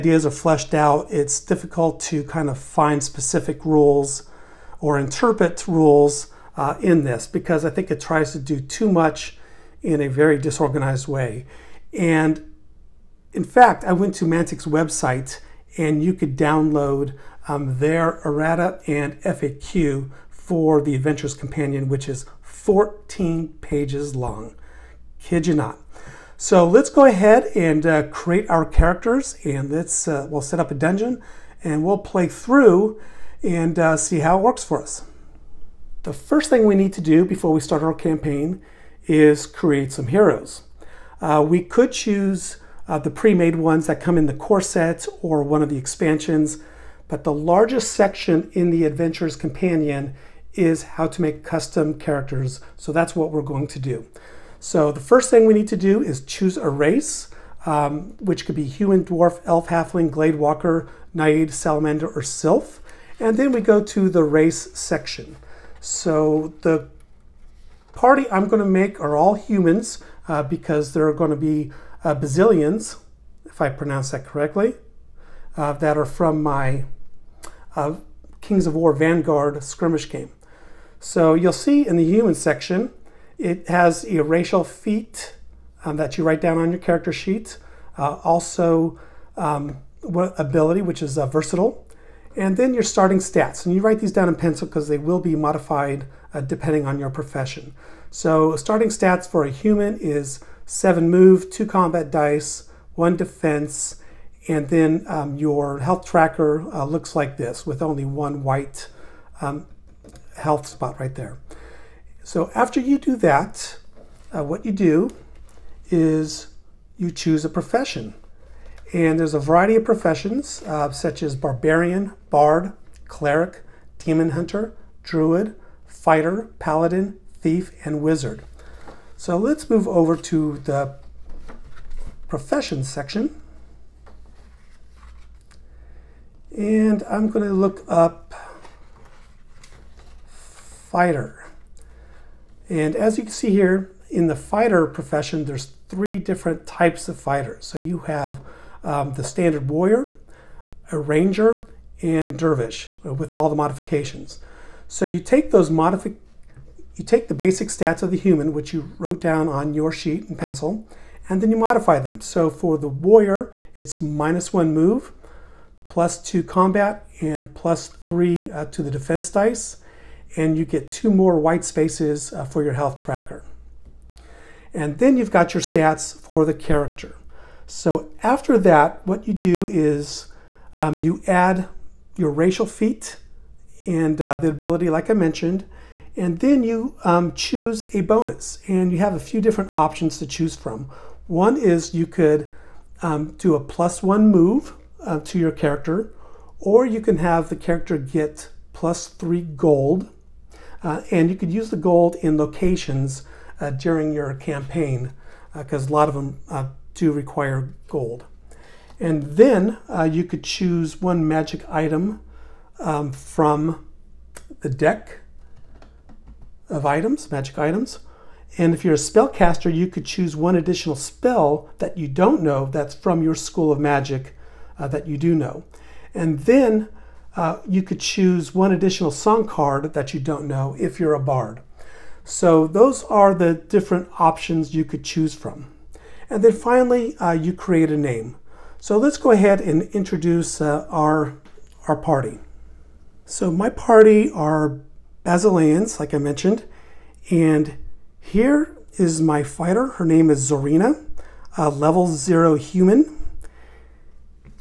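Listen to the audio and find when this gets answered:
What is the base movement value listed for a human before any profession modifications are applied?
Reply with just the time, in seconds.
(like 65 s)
100 s.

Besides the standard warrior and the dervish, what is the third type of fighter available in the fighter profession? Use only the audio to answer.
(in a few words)
Ranger.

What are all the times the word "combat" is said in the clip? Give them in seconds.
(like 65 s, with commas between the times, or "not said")
101 s, 166 s.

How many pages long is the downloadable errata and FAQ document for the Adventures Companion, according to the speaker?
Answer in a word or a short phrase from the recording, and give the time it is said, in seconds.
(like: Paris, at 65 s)
14, at 22 s.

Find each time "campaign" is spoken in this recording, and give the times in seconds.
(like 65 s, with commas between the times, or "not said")
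37 s, 204 s.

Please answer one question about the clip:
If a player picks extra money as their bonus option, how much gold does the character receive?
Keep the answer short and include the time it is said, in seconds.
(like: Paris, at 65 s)
3 gold, at 198 s.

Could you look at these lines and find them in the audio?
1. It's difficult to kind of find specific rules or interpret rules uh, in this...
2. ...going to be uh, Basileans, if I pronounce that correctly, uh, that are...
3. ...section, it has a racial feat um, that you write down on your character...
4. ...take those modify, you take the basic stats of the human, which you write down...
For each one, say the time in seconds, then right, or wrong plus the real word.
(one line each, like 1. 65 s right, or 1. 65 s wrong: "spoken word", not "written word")
1. 1 s right
2. 71 s right
3. 82 s right
4. 155 s wrong: "wrote", not "write".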